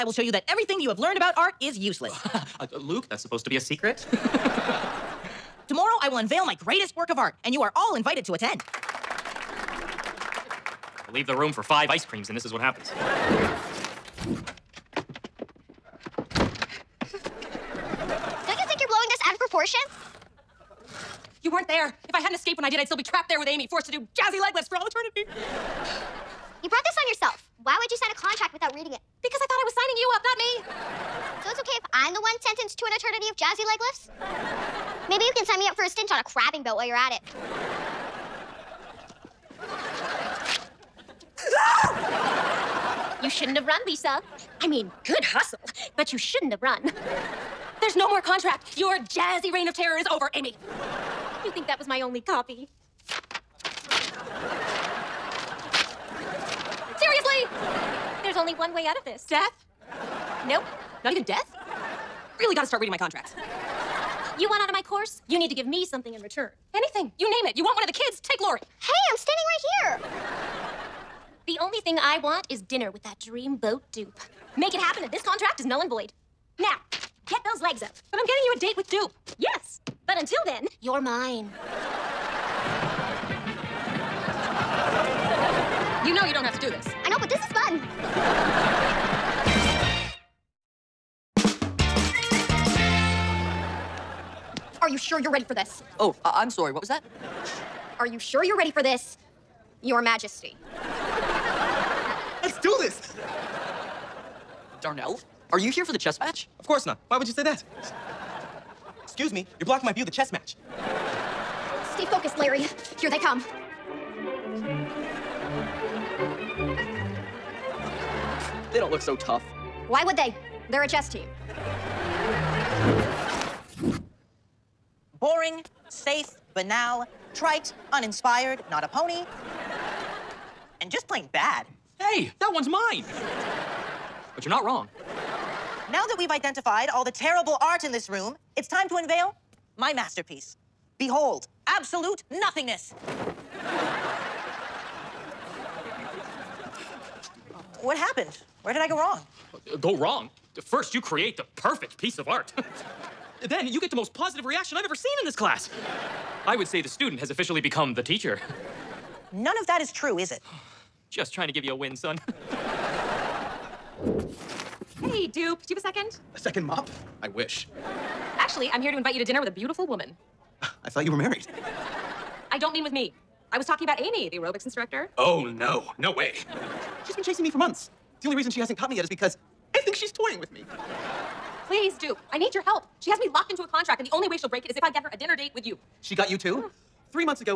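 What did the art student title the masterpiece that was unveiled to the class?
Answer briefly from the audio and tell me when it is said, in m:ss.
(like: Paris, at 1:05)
Absolute nothingness, at 2:21.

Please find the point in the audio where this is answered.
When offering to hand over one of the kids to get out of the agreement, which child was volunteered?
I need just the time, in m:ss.
1:08.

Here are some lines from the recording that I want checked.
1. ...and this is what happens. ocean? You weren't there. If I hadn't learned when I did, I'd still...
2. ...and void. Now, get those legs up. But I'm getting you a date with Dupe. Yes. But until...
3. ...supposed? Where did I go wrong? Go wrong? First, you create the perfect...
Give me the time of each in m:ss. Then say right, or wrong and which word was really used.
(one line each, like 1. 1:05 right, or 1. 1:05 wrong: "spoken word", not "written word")
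1. 0:12 wrong: "escaped", not "learned"
2. 1:15 right
3. 2:27 wrong: "happened", not "supposed".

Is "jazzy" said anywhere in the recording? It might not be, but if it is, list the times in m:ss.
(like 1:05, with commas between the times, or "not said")
0:24, 0:33, 0:48.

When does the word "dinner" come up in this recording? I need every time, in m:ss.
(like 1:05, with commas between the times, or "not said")
1:12, 2:49, 3:05.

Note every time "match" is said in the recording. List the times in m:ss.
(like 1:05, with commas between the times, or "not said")
1:46, 1:50.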